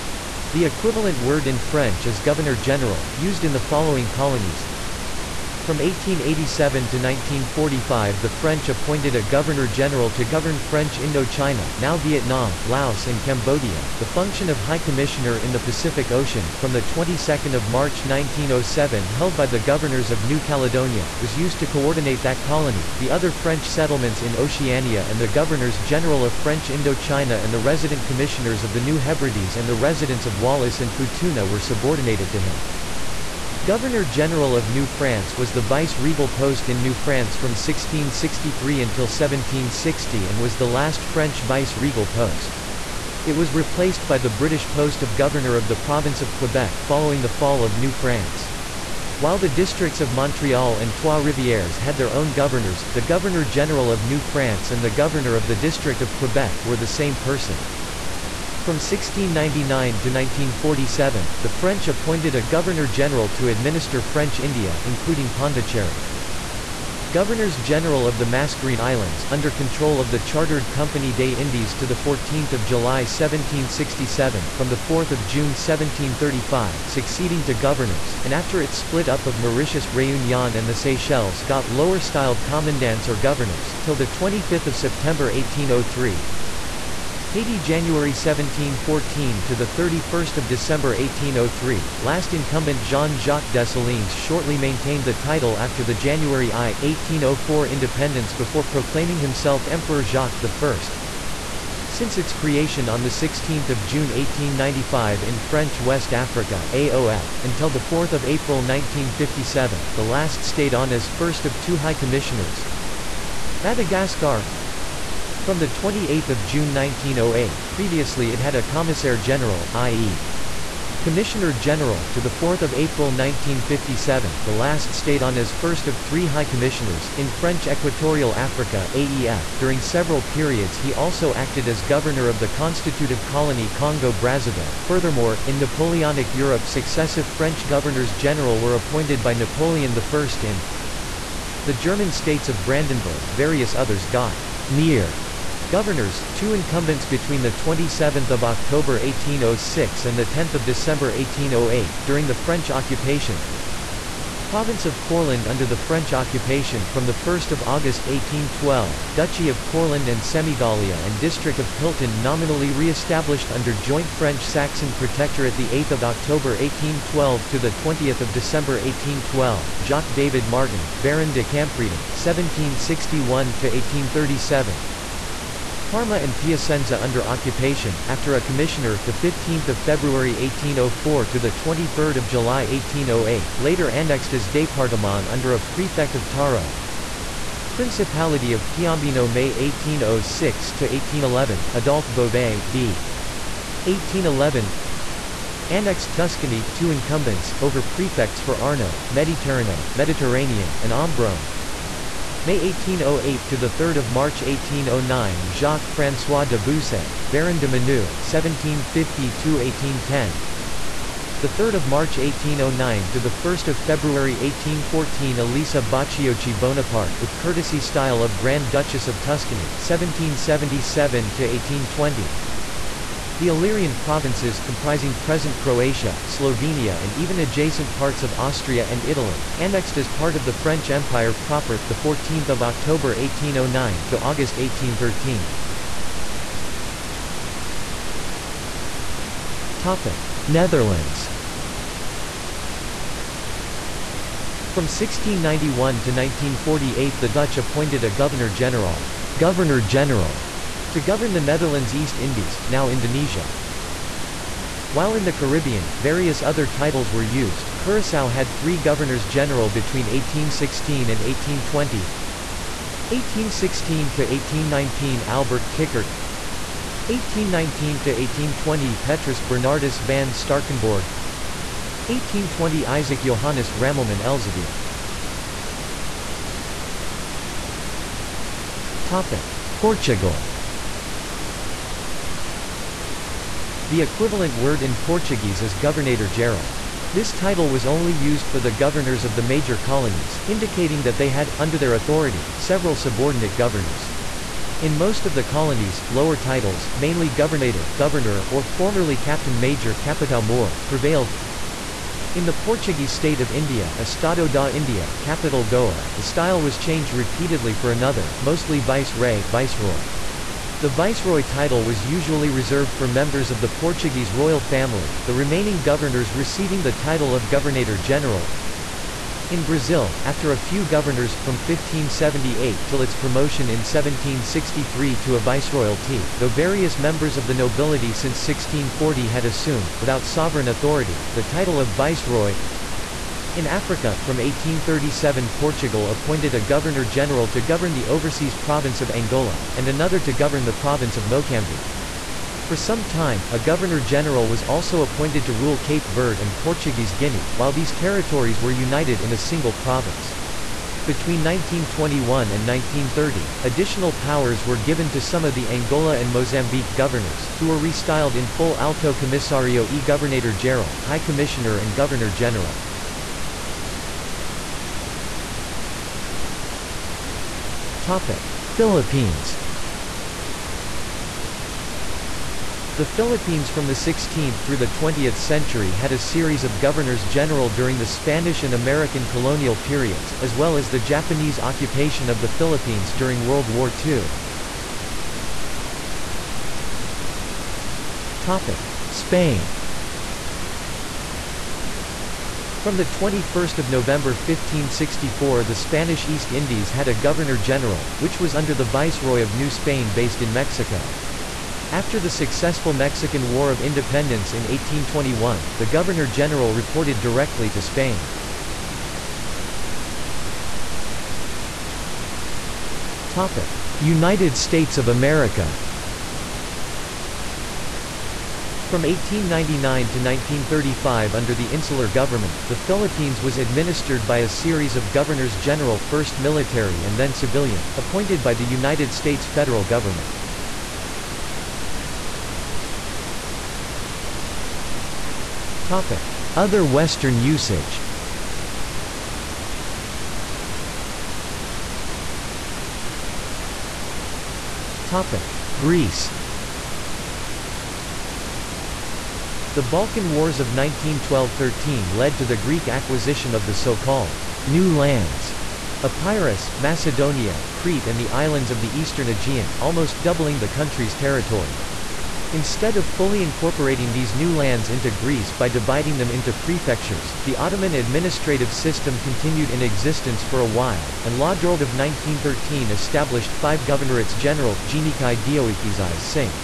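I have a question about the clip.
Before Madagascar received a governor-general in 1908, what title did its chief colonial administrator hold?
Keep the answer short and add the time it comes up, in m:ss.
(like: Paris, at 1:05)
Commissaire General, at 1:58.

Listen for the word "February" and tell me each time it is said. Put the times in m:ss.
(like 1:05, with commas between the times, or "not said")
2:59, 3:33.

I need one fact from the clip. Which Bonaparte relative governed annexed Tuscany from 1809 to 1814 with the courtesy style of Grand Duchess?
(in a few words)
Elisa Baciocchi Bonaparte.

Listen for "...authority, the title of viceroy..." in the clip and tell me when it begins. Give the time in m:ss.
5:30.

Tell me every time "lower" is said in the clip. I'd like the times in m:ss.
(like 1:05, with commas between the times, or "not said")
1:21, 4:56.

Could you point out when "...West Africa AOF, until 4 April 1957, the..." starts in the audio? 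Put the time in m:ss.
1:45.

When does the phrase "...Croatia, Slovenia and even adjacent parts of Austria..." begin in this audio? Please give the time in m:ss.
3:45.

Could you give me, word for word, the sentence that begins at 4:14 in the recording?
While in the Caribbean, various other titles were used.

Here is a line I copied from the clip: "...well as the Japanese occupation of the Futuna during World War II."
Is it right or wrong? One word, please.
wrong.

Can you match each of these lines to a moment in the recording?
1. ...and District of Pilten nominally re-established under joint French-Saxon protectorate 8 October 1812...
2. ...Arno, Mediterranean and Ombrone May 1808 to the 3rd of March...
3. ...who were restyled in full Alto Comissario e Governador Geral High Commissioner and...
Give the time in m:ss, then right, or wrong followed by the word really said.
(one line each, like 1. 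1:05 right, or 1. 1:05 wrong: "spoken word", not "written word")
1. 2:41 right
2. 3:18 right
3. 5:57 right.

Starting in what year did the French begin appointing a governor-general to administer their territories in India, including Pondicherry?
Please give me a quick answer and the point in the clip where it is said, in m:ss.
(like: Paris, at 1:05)
1699, at 0:58.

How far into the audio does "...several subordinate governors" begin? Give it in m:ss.
4:52.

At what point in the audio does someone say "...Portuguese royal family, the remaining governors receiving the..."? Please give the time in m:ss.
5:13.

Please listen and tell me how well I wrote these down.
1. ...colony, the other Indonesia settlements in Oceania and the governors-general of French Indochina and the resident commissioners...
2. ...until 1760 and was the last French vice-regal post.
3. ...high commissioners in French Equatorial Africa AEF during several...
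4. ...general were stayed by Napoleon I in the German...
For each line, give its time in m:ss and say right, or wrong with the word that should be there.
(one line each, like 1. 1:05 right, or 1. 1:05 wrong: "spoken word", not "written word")
1. 0:22 wrong: "French", not "Indonesia"
2. 0:38 right
3. 2:06 right
4. 2:18 wrong: "appointed", not "stayed".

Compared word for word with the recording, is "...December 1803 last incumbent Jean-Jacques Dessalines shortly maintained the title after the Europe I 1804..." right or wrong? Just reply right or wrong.
wrong.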